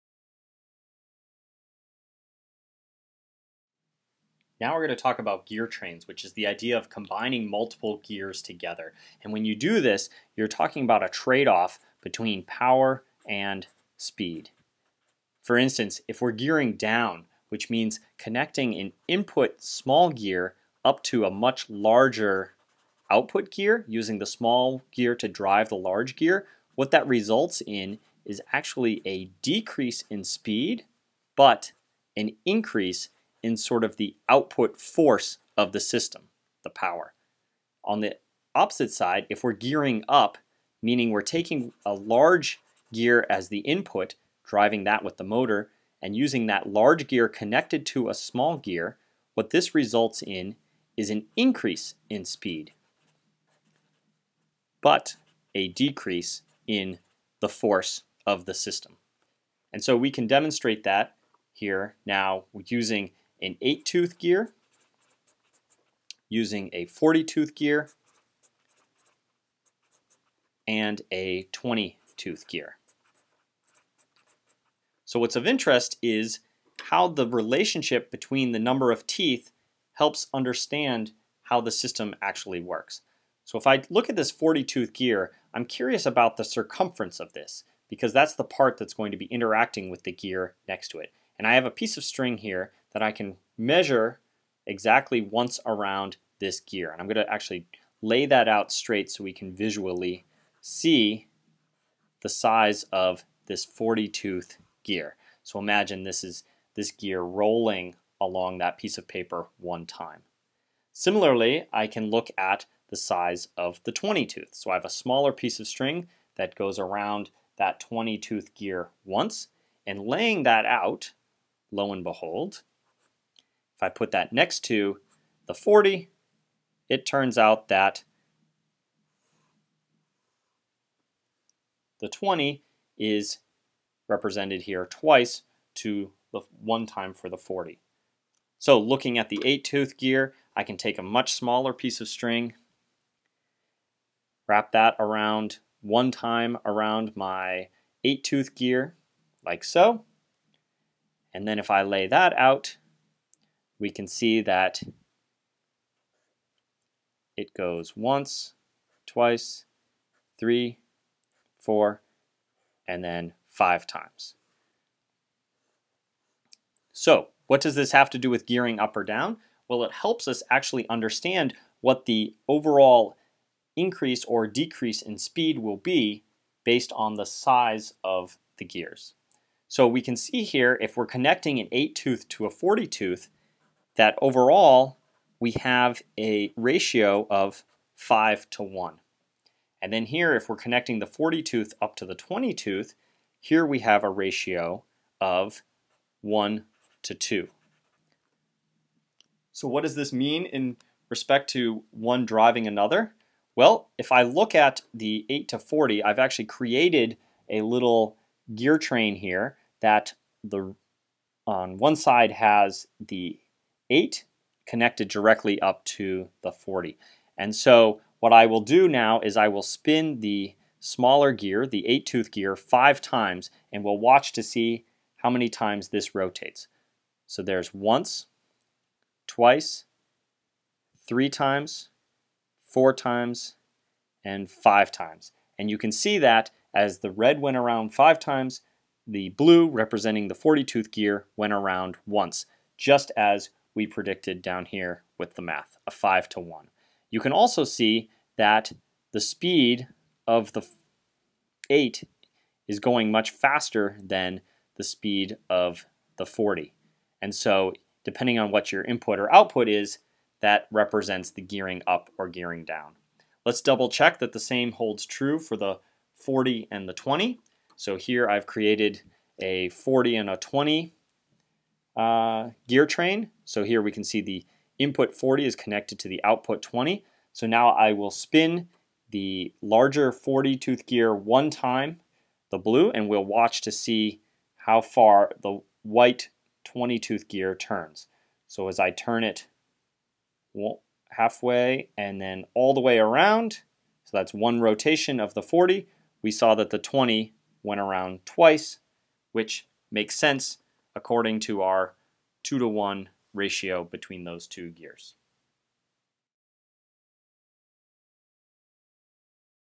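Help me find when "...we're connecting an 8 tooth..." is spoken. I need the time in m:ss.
3:00.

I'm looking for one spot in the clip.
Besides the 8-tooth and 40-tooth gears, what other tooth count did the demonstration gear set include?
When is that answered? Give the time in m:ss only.
1:11.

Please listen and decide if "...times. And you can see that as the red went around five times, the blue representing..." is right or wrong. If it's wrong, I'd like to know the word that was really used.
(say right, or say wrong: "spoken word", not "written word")
right.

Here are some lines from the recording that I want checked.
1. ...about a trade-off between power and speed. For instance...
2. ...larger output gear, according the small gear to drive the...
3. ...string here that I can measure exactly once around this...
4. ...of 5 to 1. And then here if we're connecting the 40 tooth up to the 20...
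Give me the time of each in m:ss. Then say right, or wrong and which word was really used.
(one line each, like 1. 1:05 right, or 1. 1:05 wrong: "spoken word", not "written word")
1. 0:10 right
2. 0:21 wrong: "using", not "according"
3. 1:32 right
4. 3:07 right.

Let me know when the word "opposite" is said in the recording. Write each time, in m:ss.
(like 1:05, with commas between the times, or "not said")
0:38.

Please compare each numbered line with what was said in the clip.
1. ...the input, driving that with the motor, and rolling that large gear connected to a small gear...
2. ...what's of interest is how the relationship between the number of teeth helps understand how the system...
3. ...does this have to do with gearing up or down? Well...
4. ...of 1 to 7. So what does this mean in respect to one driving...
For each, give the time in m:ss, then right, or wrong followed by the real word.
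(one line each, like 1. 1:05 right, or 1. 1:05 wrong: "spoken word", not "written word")
1. 0:43 wrong: "using", not "rolling"
2. 1:15 right
3. 2:47 right
4. 3:15 wrong: "2", not "7".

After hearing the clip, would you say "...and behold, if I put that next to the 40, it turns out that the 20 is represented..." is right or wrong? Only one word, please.
right.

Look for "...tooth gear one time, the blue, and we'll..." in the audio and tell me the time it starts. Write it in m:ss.
4:40.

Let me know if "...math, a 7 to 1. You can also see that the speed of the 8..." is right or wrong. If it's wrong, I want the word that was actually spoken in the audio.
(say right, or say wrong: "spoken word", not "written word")
wrong: "5", not "7".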